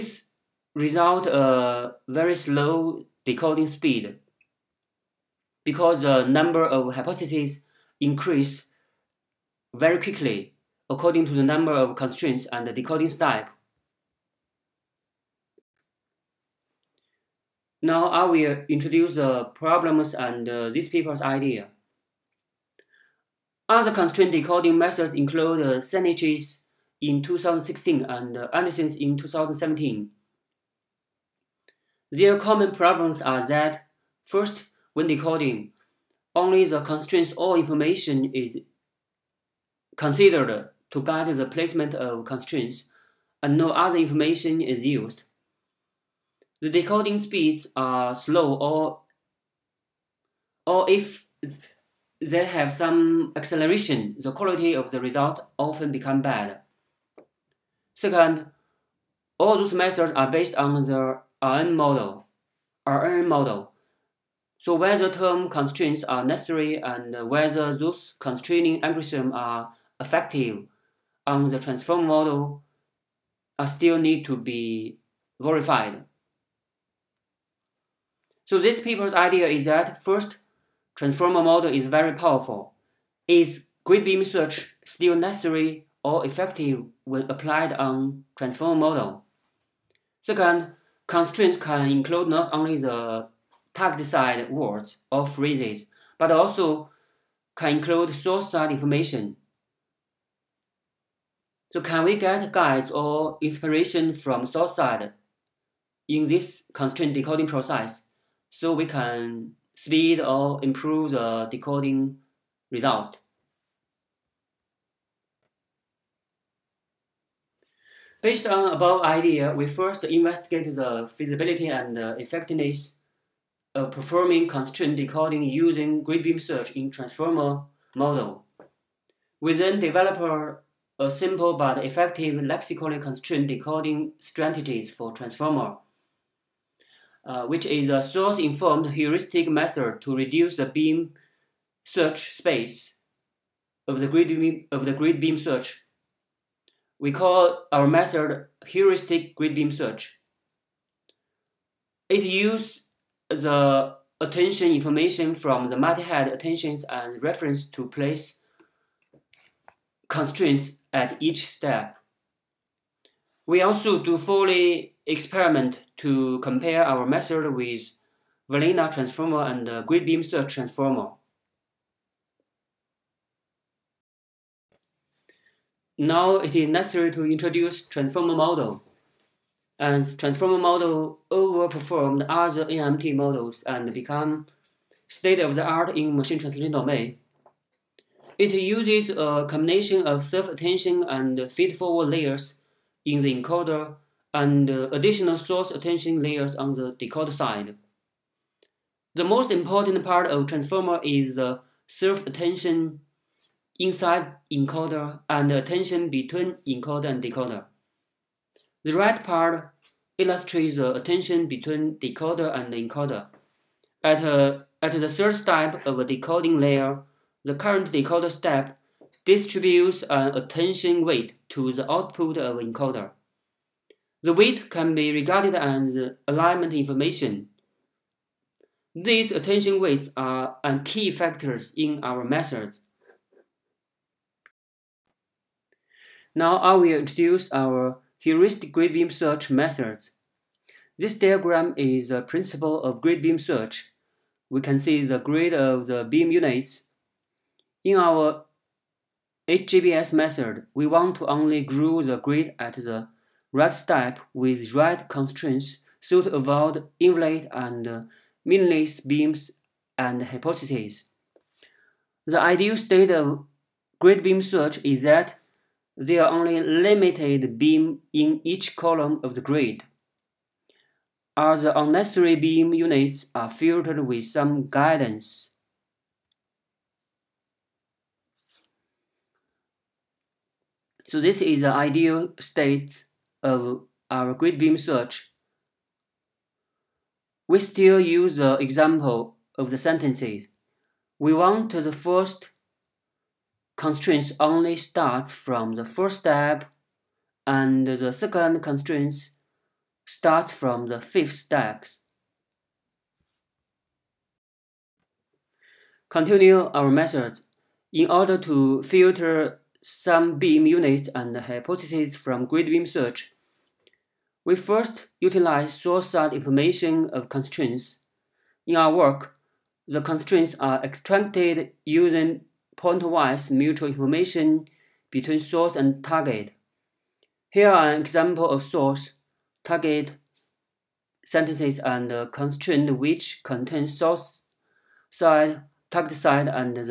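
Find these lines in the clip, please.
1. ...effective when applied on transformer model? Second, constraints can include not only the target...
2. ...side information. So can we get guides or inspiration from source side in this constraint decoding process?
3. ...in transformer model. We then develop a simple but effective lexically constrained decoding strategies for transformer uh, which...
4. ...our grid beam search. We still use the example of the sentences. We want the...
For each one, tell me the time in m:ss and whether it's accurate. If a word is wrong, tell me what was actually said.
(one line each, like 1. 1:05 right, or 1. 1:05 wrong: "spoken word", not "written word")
1. 1:26 right
2. 1:38 right
3. 2:06 right
4. 4:44 right.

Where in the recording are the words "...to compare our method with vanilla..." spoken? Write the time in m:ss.
2:45.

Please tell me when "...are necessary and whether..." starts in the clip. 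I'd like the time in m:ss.
1:06.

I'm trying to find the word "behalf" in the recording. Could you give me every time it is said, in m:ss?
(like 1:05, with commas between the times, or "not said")
not said.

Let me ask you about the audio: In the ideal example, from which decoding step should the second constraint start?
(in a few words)
fifth step.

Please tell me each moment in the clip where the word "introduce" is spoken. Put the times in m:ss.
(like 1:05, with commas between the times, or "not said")
0:18, 2:57, 3:56.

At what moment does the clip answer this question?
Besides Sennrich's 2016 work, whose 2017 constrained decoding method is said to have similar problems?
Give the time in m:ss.
0:28.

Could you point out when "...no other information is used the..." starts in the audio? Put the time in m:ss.
0:43.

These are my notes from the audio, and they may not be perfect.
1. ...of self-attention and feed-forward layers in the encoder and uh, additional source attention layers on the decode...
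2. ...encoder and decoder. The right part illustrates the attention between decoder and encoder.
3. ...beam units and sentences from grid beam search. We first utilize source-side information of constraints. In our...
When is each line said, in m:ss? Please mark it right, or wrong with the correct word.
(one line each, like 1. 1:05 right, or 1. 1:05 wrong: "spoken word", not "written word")
1. 3:10 right
2. 3:26 right
3. 5:10 wrong: "hypotheses", not "sentences".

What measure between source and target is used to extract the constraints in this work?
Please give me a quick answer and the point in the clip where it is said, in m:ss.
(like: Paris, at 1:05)
pointwise mutual information, at 5:22.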